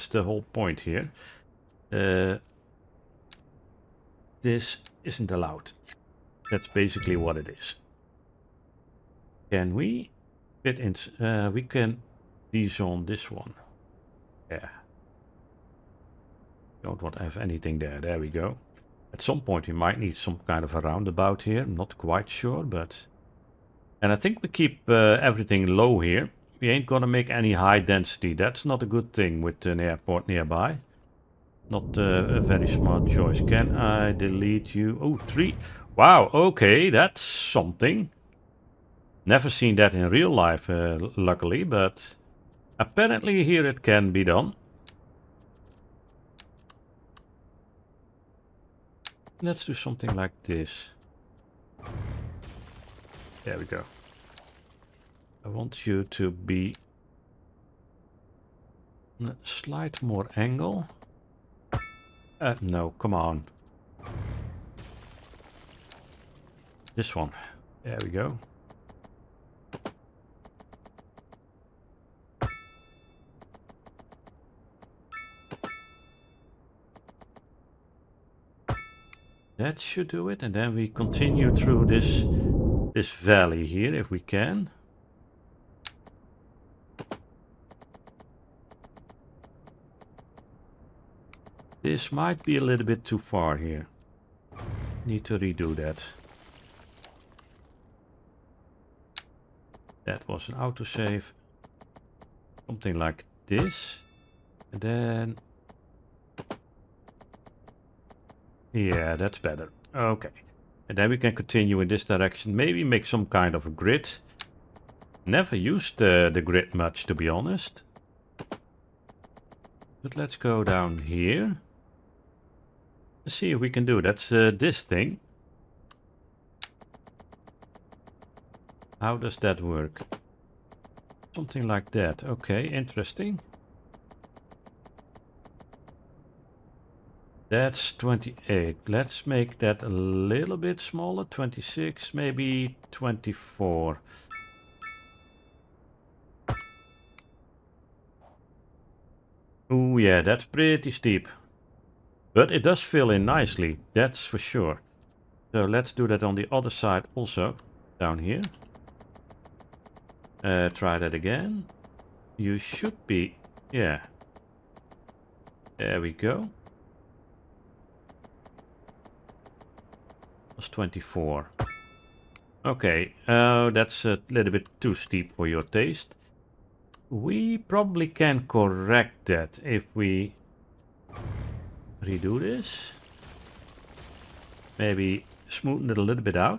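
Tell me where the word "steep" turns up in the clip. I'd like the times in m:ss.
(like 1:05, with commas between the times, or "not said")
2:30, 2:54.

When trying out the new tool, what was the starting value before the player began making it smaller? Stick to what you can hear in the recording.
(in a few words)
28.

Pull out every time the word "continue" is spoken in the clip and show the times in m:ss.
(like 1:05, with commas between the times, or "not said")
1:20, 1:51.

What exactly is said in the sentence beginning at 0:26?
We ain't gonna make any high density.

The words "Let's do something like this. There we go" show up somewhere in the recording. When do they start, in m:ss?
0:49.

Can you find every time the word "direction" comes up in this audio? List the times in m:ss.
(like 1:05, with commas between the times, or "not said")
1:52.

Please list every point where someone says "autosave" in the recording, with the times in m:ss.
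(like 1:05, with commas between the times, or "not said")
1:40.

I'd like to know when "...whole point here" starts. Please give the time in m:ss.
0:00.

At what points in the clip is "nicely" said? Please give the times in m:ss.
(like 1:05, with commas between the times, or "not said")
2:33.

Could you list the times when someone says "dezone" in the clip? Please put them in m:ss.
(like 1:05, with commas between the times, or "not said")
0:12.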